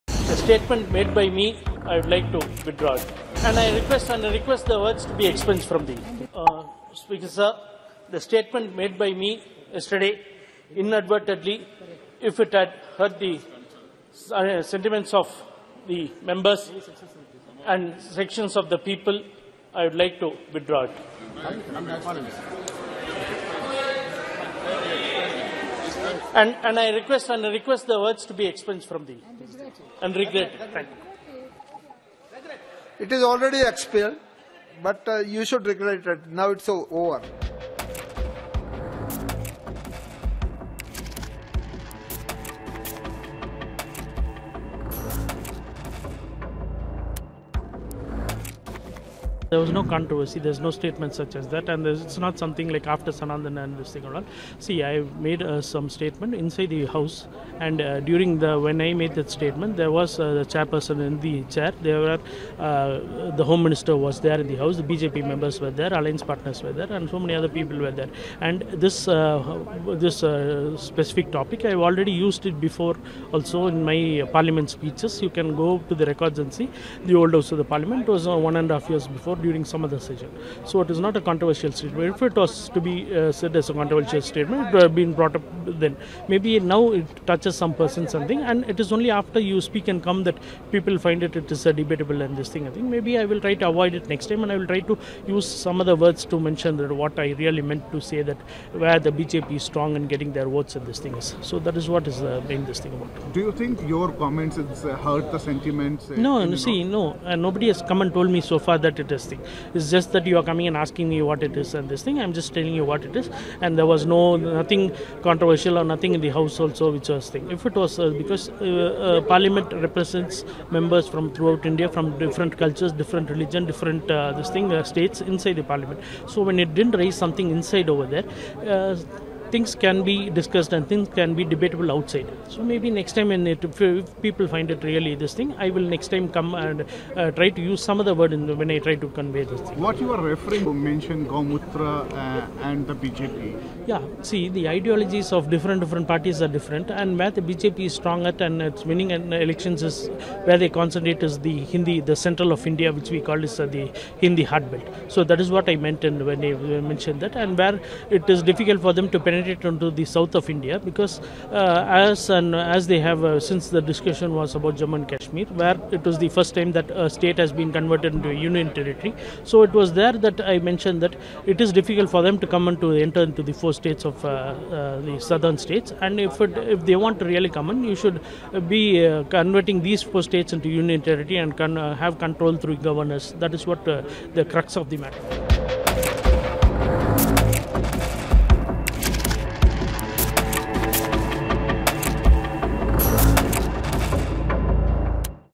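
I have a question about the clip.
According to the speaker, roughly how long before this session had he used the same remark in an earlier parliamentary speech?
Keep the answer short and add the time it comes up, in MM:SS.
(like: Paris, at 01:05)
1.5 years, at 01:18.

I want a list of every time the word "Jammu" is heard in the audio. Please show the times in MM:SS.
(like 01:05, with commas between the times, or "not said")
02:44.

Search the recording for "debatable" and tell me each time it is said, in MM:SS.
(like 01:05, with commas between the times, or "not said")
01:31, 02:11.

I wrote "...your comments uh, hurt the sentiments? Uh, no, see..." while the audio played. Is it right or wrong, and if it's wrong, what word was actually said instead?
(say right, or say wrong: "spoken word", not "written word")
right.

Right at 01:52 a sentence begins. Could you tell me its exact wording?
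I'm just telling you what it is, and there was no nothing controversial or nothing in the house also which was thing.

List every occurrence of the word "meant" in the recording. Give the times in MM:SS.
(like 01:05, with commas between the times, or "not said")
01:37, 02:35.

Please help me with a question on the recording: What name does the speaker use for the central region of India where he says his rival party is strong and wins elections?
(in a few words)
Hindi belt.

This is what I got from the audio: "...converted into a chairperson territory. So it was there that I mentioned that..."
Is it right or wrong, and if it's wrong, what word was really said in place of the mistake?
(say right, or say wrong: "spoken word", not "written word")
wrong: "union", not "chairperson".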